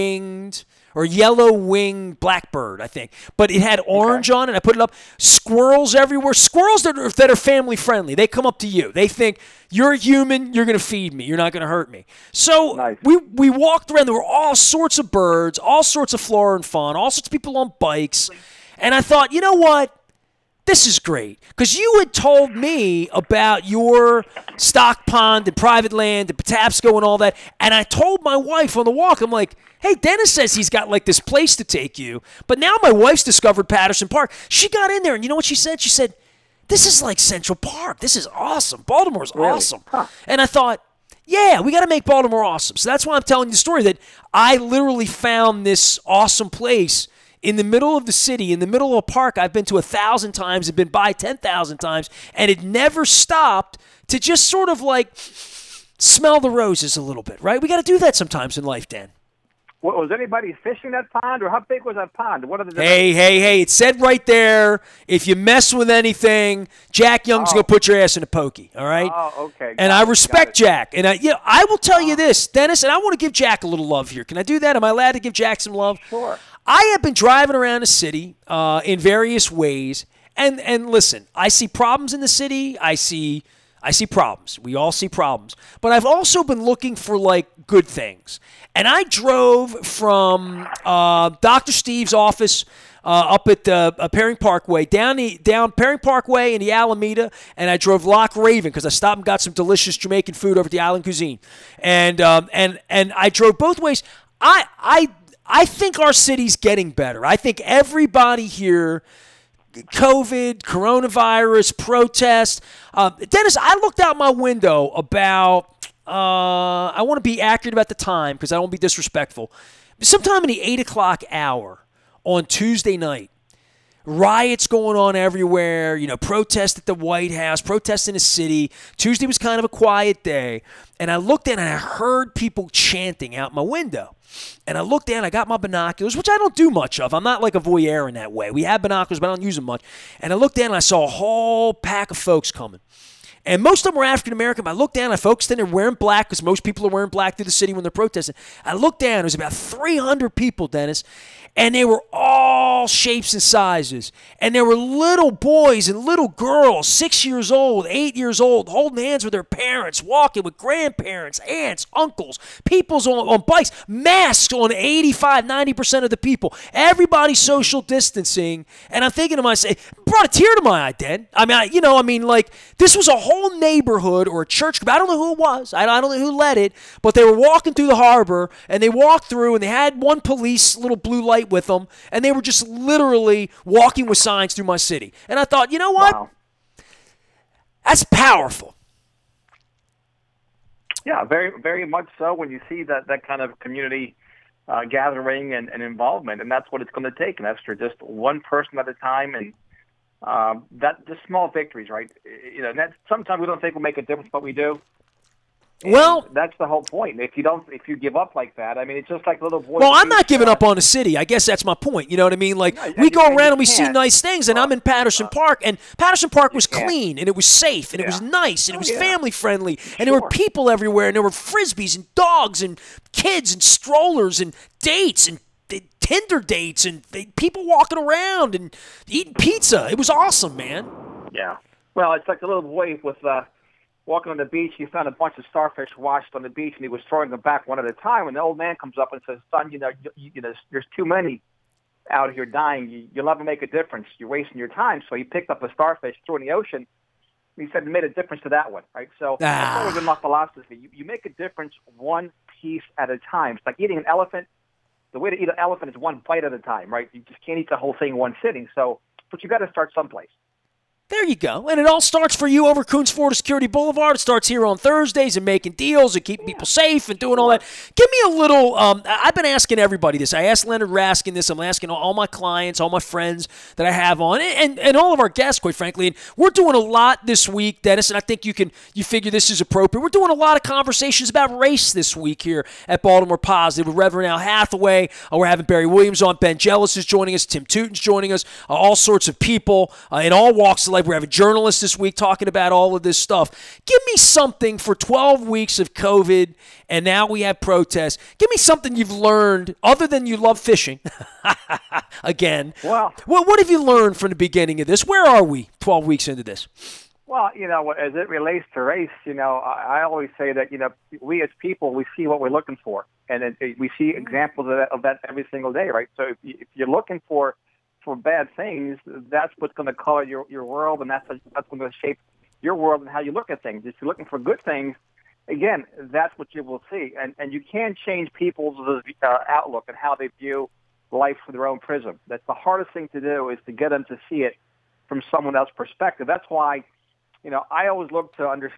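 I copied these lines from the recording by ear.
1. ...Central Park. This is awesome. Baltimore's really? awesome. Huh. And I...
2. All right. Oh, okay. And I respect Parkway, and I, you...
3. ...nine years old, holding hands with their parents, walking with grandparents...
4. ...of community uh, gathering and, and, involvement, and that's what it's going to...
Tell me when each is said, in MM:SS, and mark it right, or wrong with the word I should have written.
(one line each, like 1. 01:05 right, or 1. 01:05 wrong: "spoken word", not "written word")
1. 00:37 right
2. 01:08 wrong: "Jack", not "Parkway"
3. 02:37 wrong: "eight", not "nine"
4. 03:13 right.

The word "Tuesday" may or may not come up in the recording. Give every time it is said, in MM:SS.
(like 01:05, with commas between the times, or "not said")
02:02, 02:08.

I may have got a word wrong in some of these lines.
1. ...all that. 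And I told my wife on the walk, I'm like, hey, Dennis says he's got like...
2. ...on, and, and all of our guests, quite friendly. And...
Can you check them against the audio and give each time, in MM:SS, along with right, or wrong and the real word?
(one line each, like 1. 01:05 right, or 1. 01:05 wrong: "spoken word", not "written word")
1. 00:27 right
2. 04:34 wrong: "frankly", not "friendly".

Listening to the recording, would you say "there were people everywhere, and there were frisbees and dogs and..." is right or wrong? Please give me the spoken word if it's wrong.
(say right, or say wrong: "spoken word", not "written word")
right.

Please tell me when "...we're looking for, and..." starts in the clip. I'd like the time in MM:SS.
05:12.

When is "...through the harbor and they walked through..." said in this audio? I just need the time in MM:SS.
02:57.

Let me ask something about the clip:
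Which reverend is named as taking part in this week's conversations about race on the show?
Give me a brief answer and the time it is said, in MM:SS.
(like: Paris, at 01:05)
Al Hathaway, at 04:44.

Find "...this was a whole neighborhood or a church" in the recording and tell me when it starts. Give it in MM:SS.
02:52.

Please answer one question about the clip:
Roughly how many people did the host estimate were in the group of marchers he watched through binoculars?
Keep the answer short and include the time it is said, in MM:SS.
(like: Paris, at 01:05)
300, at 02:29.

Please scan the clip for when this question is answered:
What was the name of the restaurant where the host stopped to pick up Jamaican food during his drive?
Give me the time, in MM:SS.
01:40.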